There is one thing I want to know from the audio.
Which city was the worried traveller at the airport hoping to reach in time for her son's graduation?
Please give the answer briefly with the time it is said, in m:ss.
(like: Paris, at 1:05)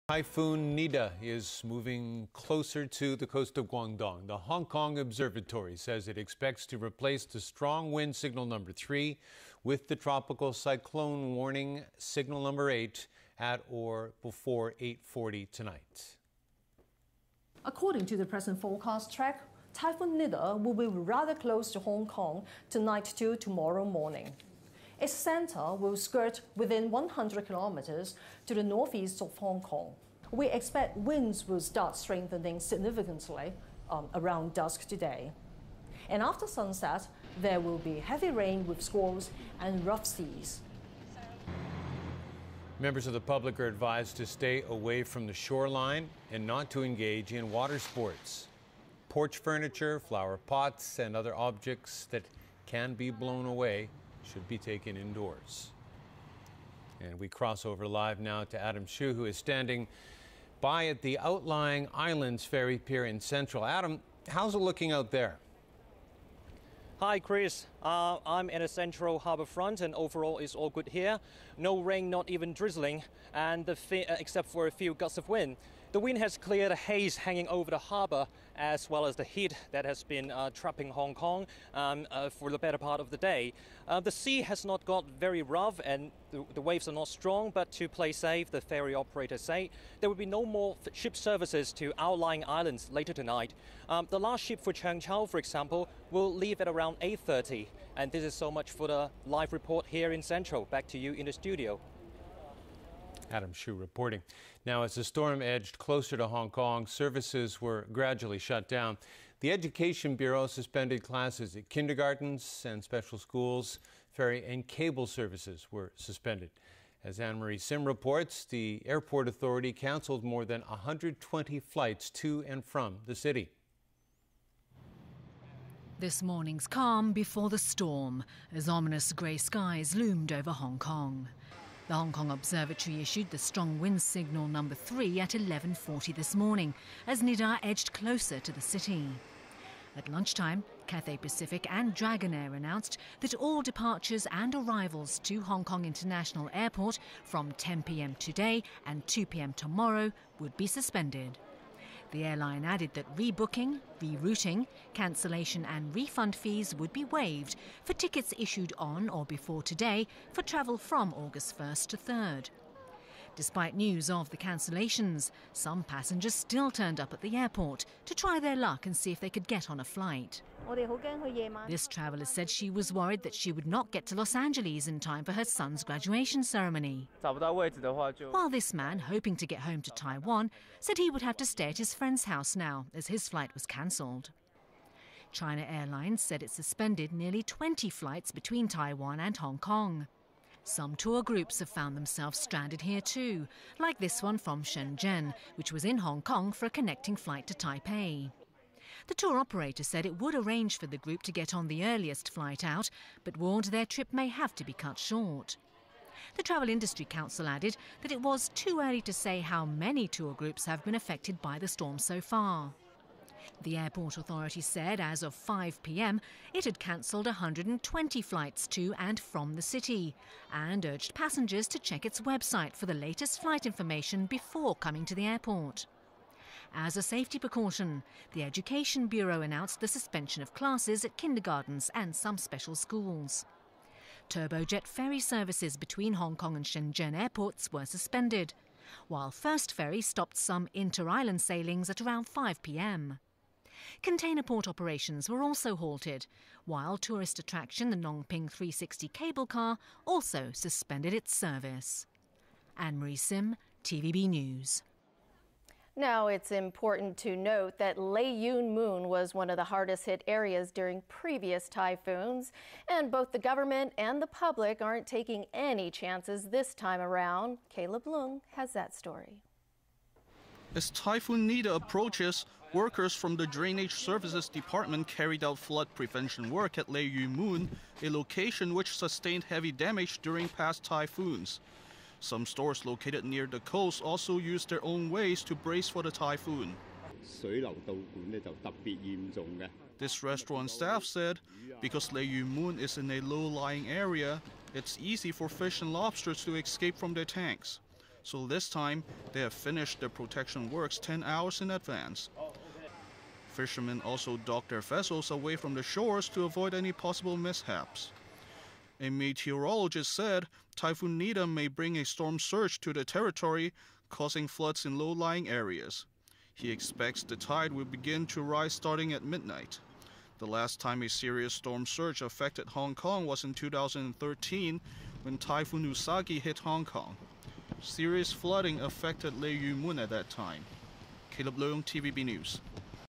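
Los Angeles, at 2:54.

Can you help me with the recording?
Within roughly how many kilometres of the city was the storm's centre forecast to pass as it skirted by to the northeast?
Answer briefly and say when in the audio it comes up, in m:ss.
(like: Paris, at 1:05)
100 kilometers, at 0:26.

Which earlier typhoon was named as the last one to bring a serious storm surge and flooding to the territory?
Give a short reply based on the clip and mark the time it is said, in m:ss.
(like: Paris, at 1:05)
Typhoon Usagi, at 5:25.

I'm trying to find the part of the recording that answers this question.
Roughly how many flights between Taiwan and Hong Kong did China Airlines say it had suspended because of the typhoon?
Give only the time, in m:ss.
3:07.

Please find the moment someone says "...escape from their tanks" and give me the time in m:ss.
4:56.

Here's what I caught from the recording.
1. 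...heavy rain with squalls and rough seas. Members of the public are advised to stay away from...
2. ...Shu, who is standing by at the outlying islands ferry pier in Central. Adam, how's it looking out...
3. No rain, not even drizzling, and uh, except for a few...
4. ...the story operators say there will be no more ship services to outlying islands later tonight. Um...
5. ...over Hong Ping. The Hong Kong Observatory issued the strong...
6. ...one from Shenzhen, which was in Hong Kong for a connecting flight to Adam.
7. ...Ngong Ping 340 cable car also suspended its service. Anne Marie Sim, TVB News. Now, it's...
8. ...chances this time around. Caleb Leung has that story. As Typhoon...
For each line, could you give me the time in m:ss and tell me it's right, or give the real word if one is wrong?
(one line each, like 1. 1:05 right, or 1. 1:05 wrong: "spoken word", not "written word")
1. 0:37 right
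2. 0:58 right
3. 1:11 right
4. 1:28 wrong: "ferry", not "story"
5. 2:10 wrong: "Kong", not "Ping"
6. 3:14 wrong: "Taipei", not "Adam"
7. 4:07 wrong: "360", not "340"
8. 4:25 right.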